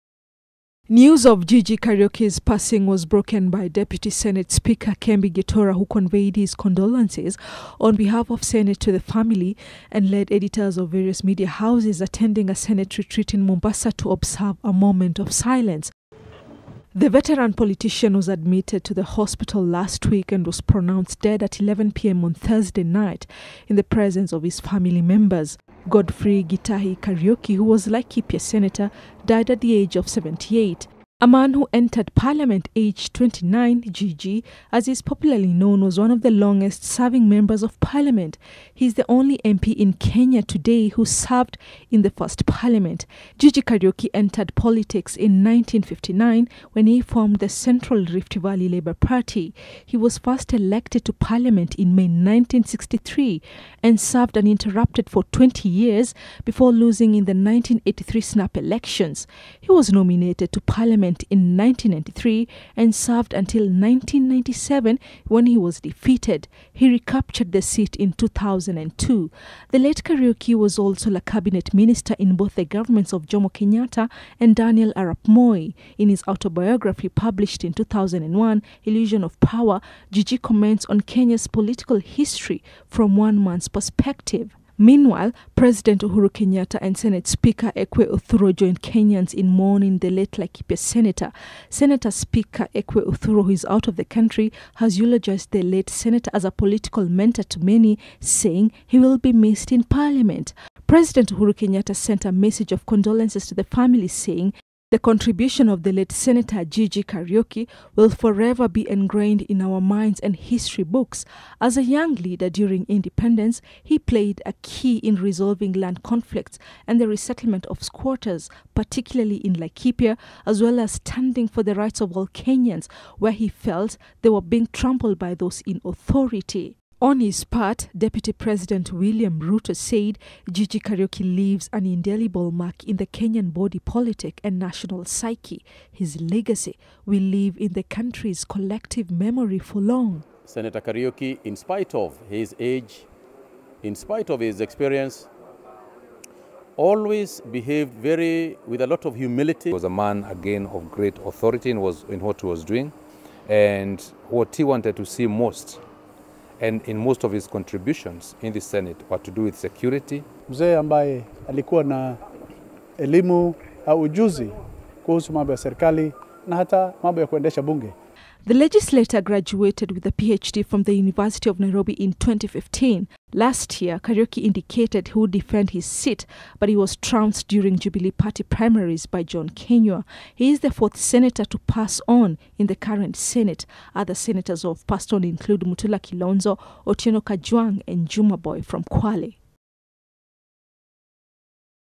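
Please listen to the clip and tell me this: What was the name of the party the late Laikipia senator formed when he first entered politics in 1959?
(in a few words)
Central Rift Valley Labour Party.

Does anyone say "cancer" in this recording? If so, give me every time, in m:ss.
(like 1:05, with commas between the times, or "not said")
not said.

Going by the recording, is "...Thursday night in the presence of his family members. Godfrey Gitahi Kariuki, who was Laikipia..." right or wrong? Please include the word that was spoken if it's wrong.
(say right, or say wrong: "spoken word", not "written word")
right.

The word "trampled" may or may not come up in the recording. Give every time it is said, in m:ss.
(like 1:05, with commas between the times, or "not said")
2:04.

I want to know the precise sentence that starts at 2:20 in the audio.
Senator Kariuki, in spite of his age, in spite of his experience, always behaved very with a lot of humility.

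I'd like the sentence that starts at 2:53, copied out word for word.
Last year, Kariuki indicated he would defend his seat, but he was trounced during Jubilee Party primaries by John Kinyua.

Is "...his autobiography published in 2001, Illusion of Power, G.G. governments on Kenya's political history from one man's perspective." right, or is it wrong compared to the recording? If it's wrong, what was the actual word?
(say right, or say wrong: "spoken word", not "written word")
wrong: "comments", not "governments".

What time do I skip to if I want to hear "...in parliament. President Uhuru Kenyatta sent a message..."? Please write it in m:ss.
1:39.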